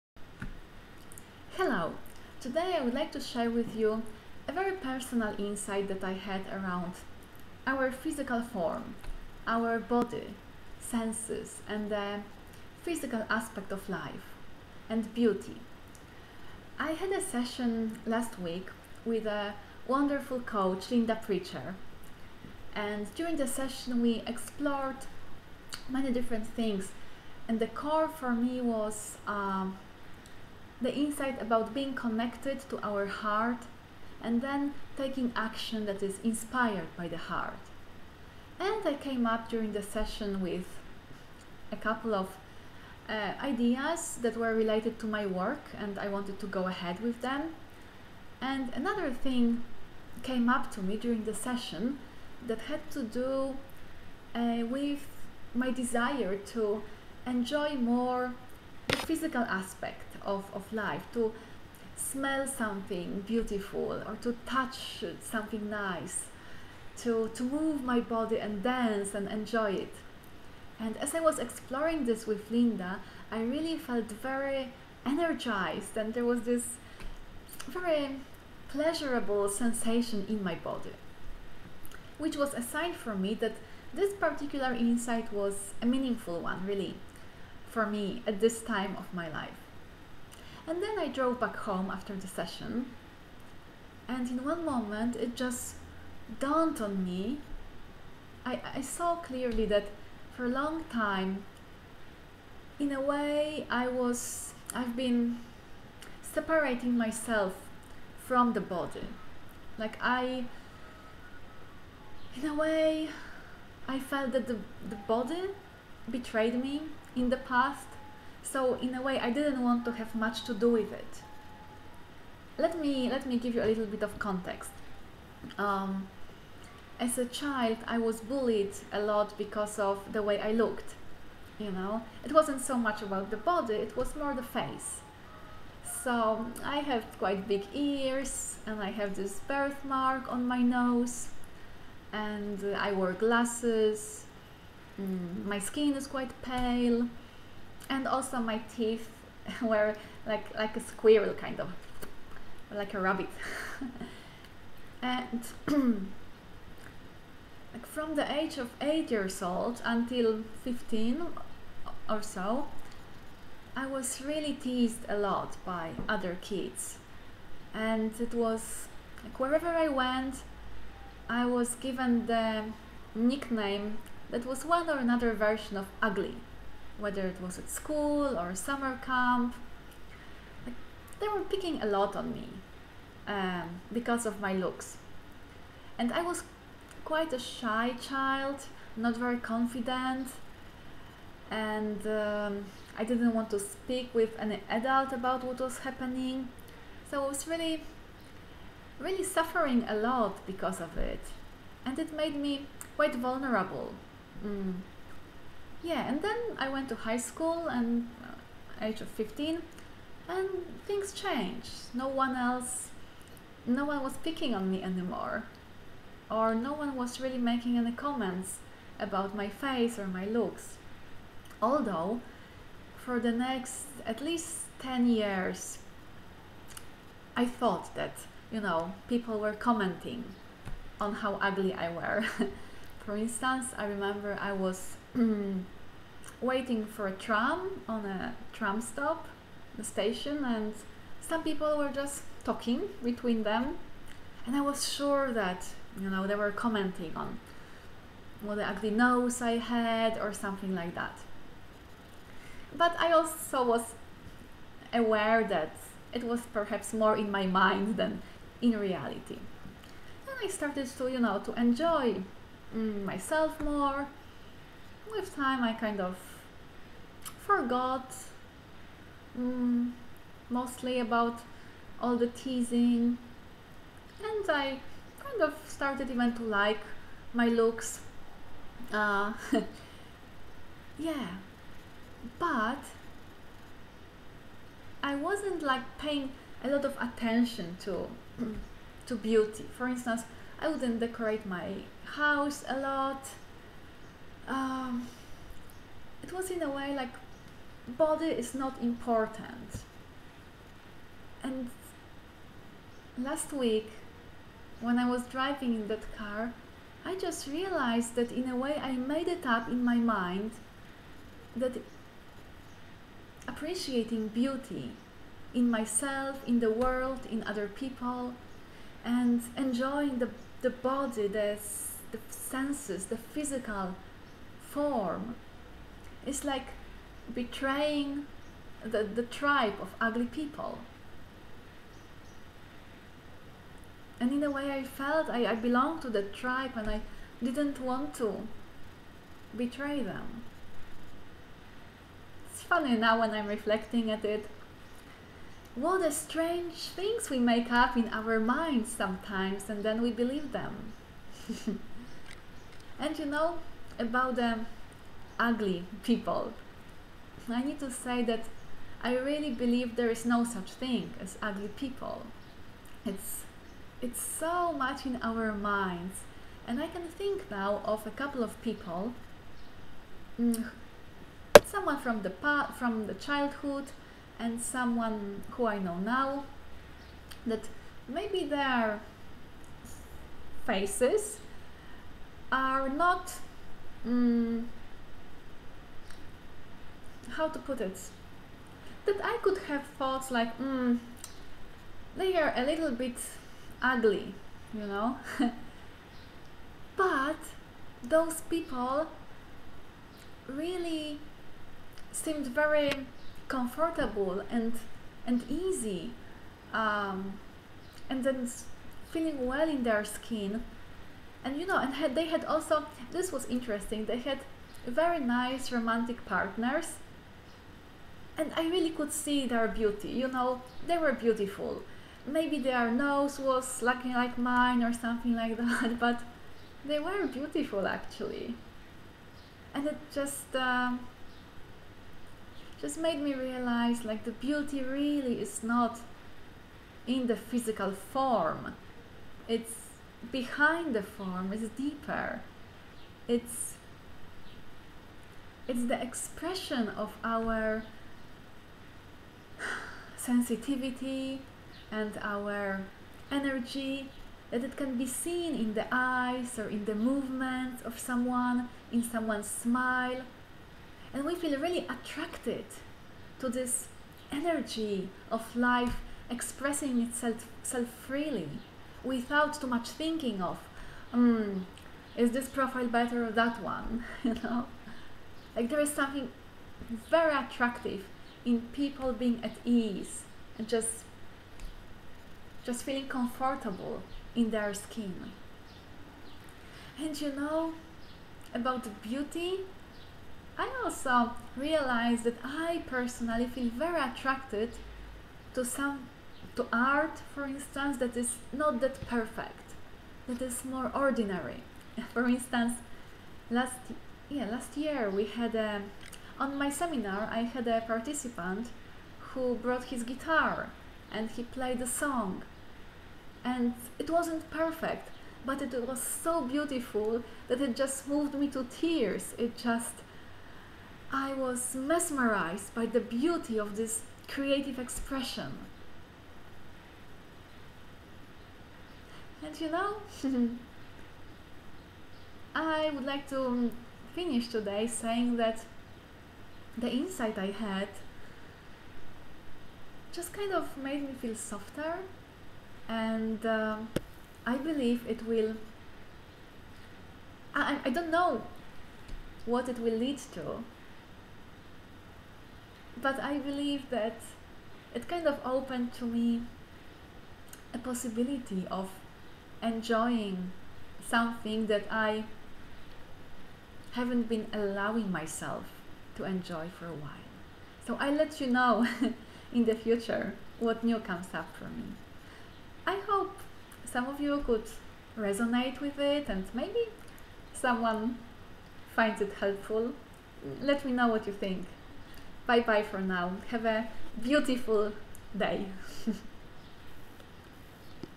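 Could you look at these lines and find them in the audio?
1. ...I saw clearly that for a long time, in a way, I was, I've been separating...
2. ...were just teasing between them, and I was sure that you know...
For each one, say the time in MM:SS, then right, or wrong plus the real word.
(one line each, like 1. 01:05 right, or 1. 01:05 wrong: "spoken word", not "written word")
1. 01:38 right
2. 04:01 wrong: "talking", not "teasing".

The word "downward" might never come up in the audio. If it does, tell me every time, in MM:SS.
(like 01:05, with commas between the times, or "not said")
not said.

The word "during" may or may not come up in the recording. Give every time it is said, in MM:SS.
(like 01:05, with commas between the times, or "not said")
00:23, 00:39, 00:50.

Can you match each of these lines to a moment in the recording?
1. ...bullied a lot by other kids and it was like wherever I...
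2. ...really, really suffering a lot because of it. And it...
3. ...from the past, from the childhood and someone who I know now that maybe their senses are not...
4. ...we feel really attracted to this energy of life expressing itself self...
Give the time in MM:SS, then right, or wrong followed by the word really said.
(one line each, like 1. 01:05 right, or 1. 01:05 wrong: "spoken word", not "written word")
1. 02:44 wrong: "teased", not "bullied"
2. 03:17 right
3. 06:11 wrong: "faces", not "senses"
4. 07:41 right.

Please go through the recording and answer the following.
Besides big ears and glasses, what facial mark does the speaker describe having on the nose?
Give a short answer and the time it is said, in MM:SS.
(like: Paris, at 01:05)
Birthmark, at 02:19.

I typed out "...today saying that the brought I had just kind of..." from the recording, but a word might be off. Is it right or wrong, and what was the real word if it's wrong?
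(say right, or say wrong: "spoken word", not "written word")
wrong: "insight", not "brought".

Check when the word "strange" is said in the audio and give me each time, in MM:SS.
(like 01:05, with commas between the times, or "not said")
05:46.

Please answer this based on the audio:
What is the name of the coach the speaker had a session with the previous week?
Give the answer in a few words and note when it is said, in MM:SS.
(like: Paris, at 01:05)
Linda Preacher, at 00:20.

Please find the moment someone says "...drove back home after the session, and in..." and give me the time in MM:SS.
01:31.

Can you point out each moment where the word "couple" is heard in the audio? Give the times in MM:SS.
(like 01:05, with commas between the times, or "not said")
00:41, 06:08.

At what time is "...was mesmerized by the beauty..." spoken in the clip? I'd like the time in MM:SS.
08:41.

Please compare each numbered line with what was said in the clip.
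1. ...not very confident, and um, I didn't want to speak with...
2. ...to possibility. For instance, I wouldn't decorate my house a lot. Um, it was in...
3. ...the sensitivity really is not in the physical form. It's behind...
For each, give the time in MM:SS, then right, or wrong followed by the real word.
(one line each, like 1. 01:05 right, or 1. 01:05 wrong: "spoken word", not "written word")
1. 03:08 right
2. 04:49 wrong: "beauty", not "possibility"
3. 07:14 wrong: "beauty", not "sensitivity".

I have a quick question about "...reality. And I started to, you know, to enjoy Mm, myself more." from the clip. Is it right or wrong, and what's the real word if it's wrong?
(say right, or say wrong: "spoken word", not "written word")
right.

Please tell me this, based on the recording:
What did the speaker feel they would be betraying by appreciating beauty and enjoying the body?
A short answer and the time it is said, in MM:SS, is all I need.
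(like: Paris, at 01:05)
The tribe of ugly people, at 05:29.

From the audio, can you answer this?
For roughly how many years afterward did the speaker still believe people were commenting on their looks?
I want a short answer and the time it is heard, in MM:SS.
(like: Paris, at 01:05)
10, at 03:44.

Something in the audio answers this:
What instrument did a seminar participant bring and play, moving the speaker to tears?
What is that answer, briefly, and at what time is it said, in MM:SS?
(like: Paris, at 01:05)
Guitar, at 08:30.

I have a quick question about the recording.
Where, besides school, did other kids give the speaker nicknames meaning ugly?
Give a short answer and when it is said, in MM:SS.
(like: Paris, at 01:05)
Summer camp, at 02:58.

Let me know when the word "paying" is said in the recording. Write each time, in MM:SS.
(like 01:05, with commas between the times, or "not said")
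04:45.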